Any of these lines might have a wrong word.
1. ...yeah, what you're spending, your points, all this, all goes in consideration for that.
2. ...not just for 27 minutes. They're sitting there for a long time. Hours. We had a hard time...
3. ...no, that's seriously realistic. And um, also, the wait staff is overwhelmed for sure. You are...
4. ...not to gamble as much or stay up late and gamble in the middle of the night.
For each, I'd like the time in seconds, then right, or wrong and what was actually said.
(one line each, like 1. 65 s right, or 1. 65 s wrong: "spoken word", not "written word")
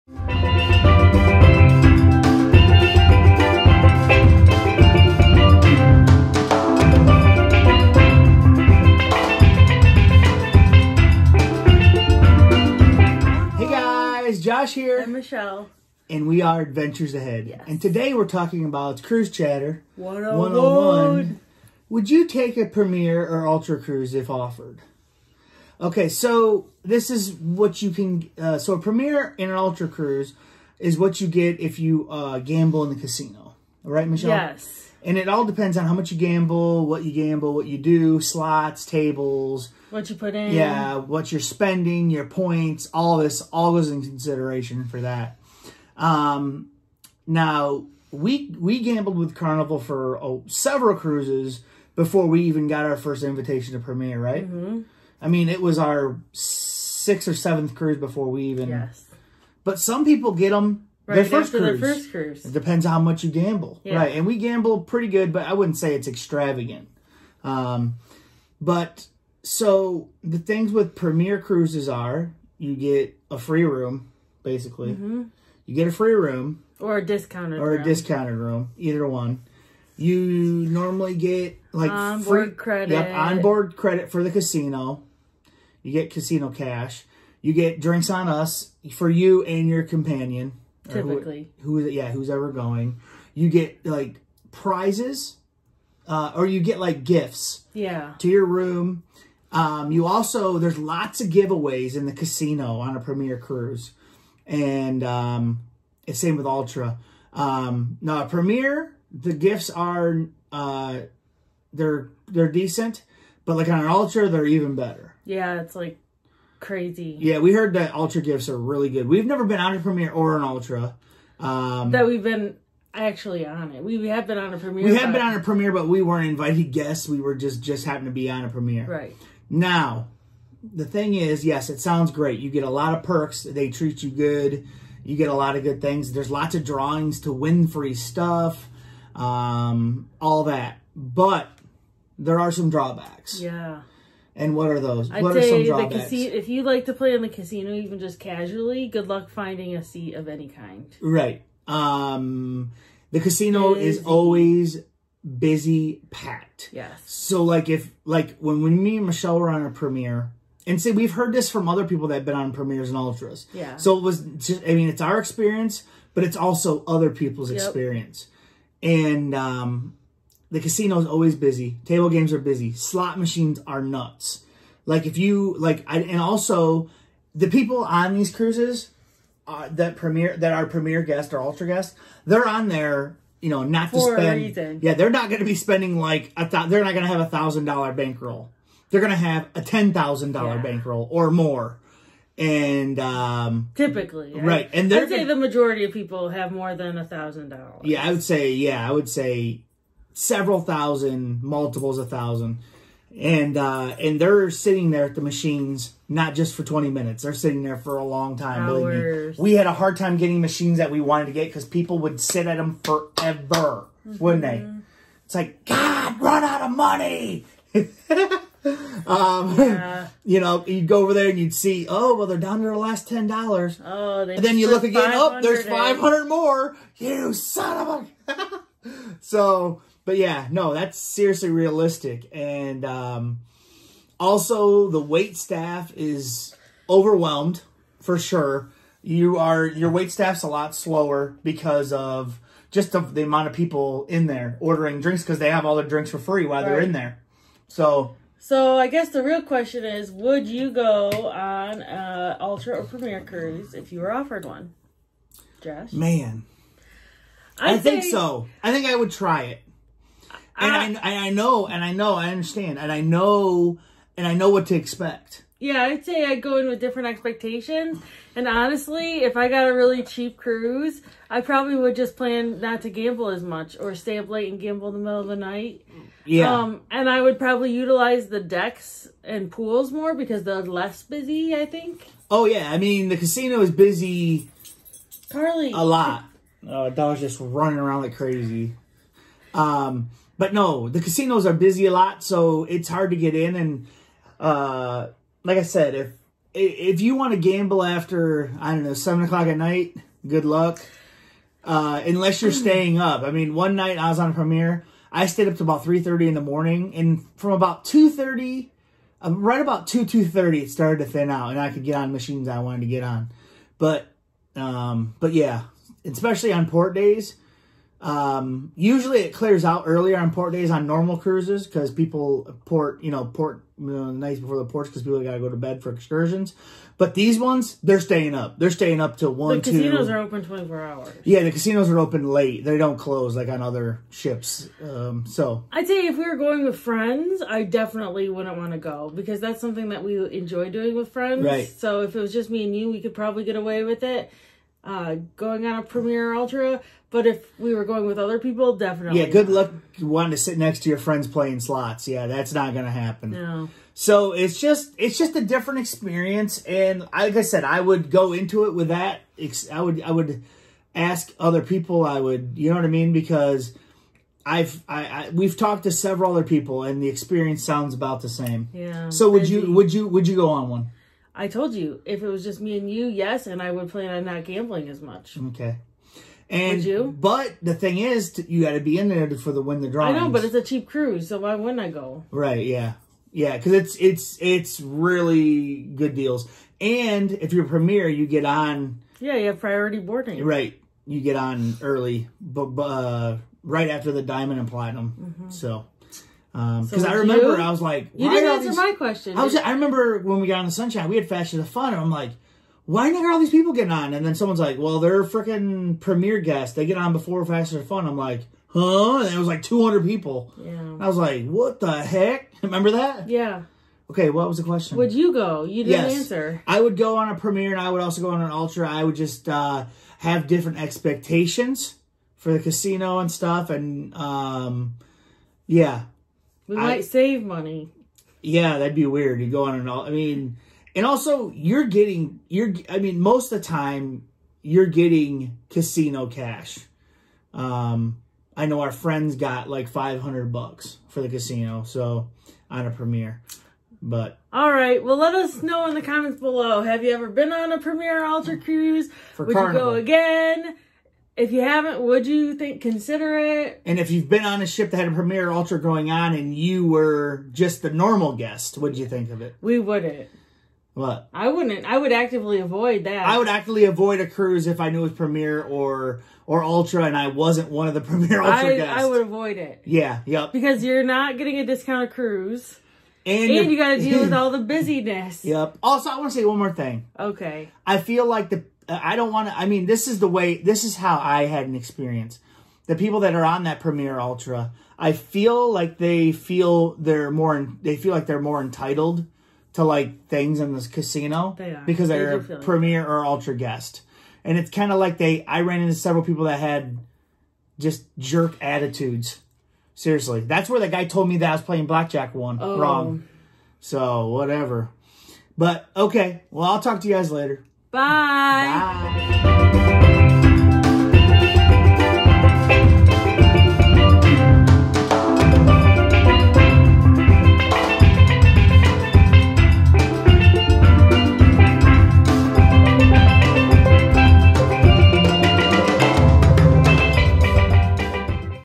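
1. 40 s right
2. 206 s wrong: "20", not "27"
3. 230 s right
4. 272 s right.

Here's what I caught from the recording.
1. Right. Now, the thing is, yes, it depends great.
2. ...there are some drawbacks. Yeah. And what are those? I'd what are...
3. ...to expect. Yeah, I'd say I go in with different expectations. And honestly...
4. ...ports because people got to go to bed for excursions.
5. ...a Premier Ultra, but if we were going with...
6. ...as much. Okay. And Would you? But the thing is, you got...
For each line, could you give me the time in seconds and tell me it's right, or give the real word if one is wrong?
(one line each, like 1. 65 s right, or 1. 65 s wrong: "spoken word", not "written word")
1. 128 s wrong: "sounds", not "depends"
2. 142 s right
3. 264 s right
4. 324 s right
5. 345 s right
6. 374 s right.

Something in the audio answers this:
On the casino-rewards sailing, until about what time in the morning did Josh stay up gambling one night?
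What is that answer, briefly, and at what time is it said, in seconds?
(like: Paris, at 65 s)
3:30, at 305 s.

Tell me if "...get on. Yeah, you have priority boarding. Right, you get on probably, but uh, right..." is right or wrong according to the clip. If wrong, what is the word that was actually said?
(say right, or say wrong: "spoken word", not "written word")
wrong: "early", not "probably".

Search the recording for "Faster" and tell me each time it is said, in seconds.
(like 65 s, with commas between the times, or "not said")
401 s, 407 s.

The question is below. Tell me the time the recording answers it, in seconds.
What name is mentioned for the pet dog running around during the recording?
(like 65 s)
285 s.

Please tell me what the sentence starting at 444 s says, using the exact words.
But all right, well, let us know in the comments below.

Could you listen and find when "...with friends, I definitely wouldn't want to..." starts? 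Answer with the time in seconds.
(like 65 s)
336 s.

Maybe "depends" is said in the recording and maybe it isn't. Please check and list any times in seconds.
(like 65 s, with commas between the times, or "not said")
35 s, 62 s.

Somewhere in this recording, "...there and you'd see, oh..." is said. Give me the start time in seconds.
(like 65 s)
221 s.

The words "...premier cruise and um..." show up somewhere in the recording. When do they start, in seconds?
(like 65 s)
102 s.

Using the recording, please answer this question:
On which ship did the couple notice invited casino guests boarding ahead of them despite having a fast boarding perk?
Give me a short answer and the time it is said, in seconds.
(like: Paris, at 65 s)
Sunshine, at 400 s.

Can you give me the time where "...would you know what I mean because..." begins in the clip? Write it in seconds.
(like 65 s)
362 s.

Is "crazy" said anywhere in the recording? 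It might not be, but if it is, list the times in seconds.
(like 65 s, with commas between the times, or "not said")
116 s, 288 s.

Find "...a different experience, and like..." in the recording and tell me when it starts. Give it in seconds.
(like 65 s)
355 s.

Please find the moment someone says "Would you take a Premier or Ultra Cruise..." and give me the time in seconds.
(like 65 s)
21 s.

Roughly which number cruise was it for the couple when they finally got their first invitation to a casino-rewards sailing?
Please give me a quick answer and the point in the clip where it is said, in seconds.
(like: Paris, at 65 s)
6th or 7th, at 56 s.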